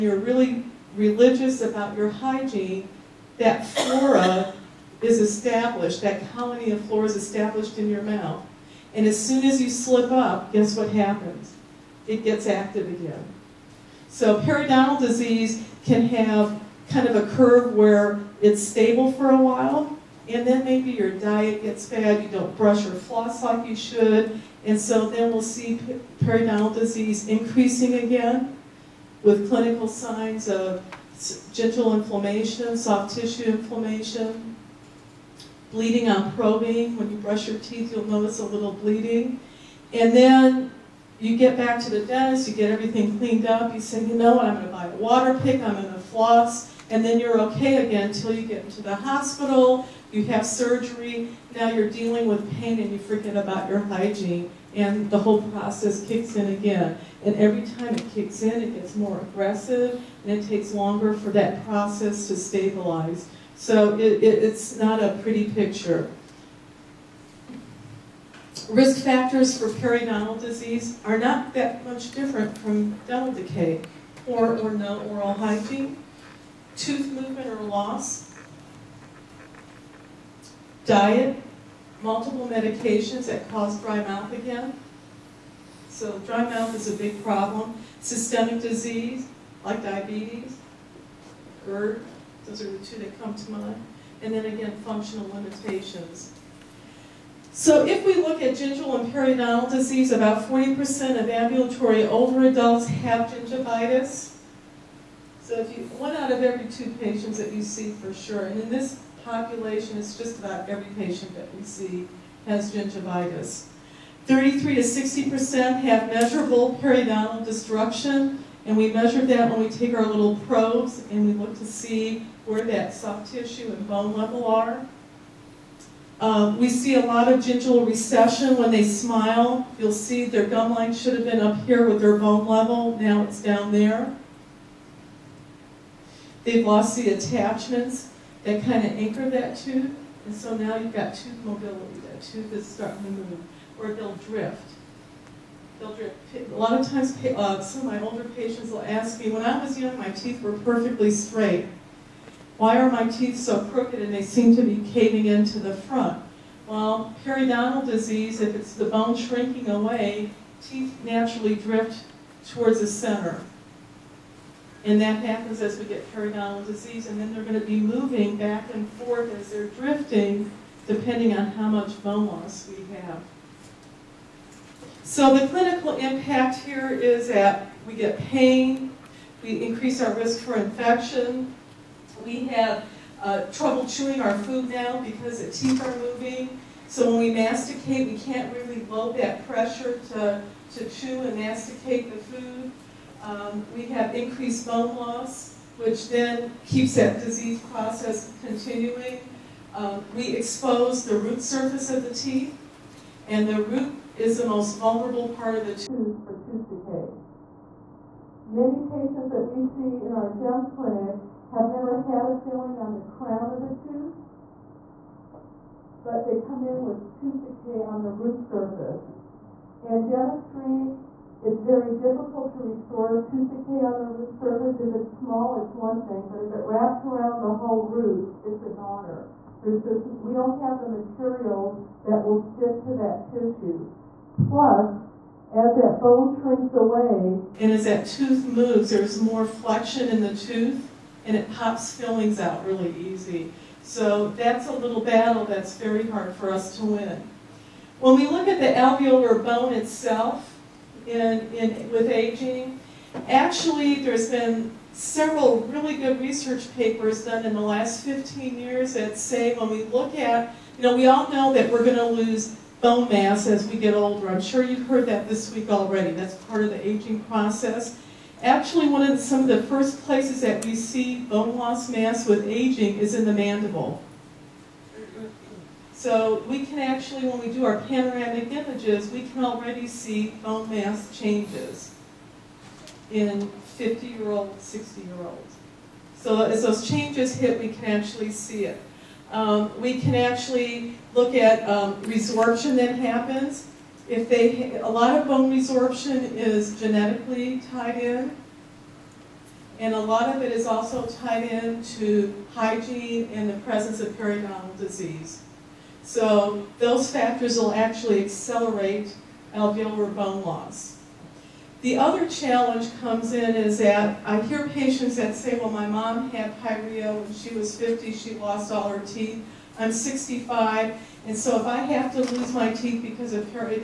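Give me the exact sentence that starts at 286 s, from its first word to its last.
So as those changes hit, we can actually see it.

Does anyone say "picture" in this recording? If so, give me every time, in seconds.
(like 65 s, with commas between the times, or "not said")
65 s.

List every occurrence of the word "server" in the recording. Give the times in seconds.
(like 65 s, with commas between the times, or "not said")
not said.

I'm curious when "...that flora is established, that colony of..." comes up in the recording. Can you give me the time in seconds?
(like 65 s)
3 s.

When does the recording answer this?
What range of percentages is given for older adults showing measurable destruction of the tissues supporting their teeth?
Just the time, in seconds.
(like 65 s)
114 s.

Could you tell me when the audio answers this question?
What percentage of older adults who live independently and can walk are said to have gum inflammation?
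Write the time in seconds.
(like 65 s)
100 s.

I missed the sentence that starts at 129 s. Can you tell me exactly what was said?
You'll see their gum line should have been up here with their bone level.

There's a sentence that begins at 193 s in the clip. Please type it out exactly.
Um, we have increased bone loss, which then keeps that disease process continuing.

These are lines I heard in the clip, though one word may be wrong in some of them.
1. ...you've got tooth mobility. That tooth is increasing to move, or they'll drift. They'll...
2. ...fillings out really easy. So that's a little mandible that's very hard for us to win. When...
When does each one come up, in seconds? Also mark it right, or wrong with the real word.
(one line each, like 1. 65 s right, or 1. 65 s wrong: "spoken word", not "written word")
1. 140 s wrong: "starting", not "increasing"
2. 241 s wrong: "battle", not "mandible".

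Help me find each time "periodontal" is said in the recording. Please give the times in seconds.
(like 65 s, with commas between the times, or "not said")
14 s, 26 s, 69 s, 99 s, 116 s, 157 s, 166 s, 304 s.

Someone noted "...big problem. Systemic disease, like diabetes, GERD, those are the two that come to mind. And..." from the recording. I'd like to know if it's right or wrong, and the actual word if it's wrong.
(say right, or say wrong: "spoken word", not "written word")
right.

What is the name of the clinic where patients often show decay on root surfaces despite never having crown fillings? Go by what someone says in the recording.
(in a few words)
GEM clinic.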